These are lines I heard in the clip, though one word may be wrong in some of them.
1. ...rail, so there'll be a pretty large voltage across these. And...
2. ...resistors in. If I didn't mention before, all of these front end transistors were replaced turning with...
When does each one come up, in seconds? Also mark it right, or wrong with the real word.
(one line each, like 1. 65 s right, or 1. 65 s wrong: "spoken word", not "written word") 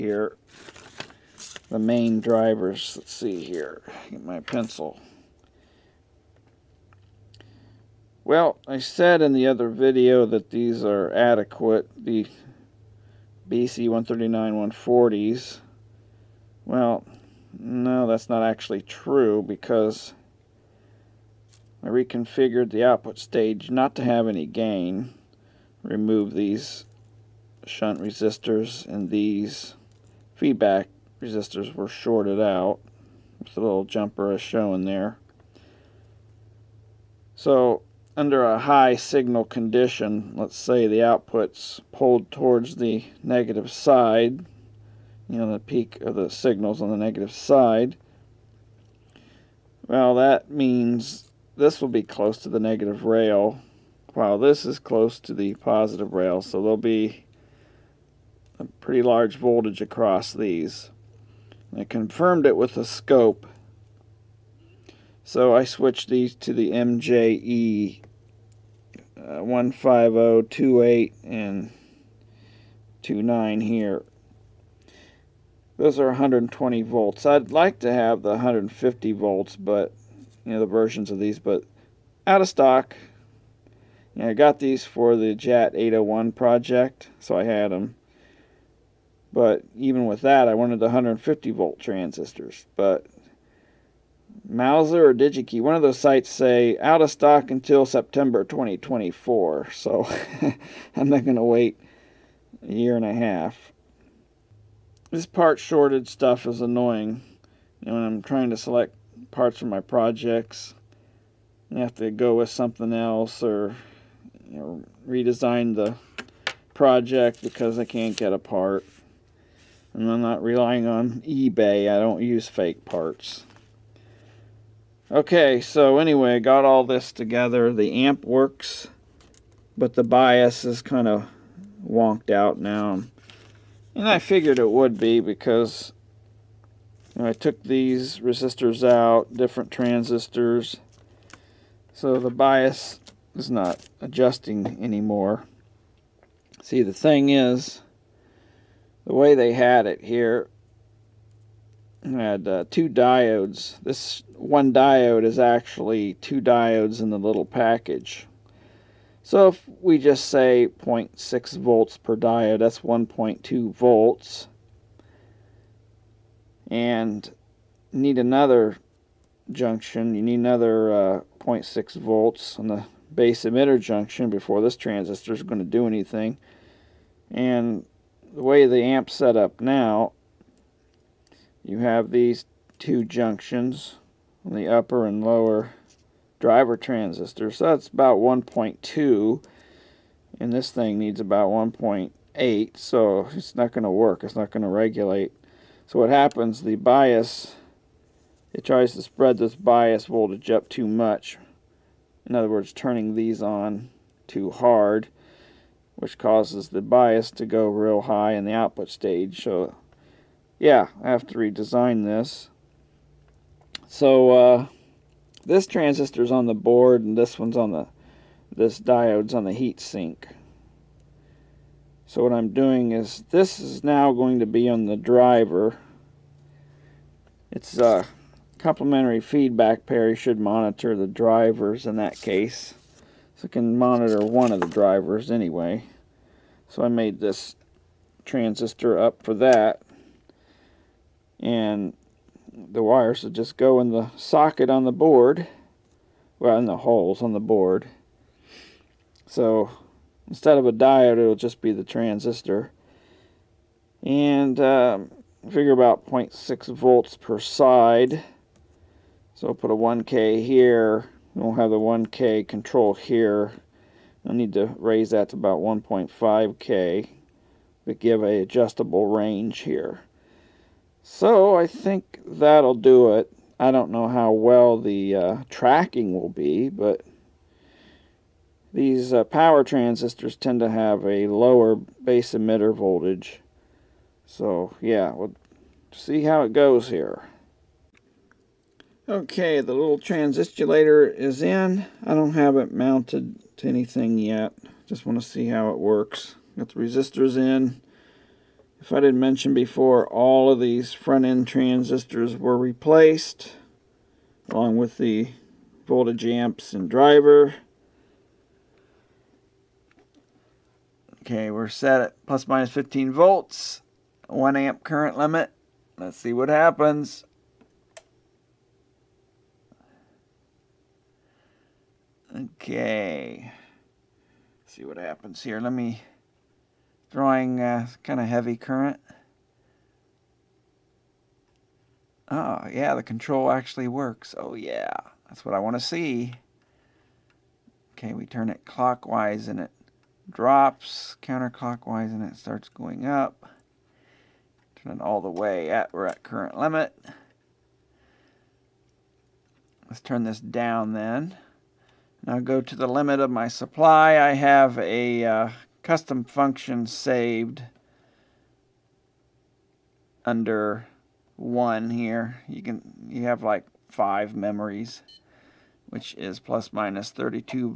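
1. 56 s right
2. 296 s wrong: "along", not "turning".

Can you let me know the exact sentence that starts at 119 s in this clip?
And I'm not relying on eBay.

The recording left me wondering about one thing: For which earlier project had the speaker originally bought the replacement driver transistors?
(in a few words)
JAT 801.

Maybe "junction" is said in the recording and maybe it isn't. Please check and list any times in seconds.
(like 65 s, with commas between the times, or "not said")
169 s, 173 s, 183 s.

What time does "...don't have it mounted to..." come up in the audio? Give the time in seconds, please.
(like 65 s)
292 s.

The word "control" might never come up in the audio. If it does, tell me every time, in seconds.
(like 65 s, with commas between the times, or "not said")
262 s, 333 s.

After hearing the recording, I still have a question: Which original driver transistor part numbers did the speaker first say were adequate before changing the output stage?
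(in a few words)
BC139/140.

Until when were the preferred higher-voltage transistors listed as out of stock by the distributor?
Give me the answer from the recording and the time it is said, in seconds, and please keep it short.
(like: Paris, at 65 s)
September 2024, at 97 s.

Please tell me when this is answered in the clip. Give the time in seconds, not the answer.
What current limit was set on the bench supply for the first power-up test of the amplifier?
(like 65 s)
314 s.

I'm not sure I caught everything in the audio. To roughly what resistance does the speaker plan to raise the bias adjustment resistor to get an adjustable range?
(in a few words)
1.5k.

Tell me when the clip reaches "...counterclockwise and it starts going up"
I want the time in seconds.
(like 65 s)
341 s.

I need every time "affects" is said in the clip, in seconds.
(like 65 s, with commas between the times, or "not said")
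not said.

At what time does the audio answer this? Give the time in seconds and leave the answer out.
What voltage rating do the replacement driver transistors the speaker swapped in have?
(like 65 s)
76 s.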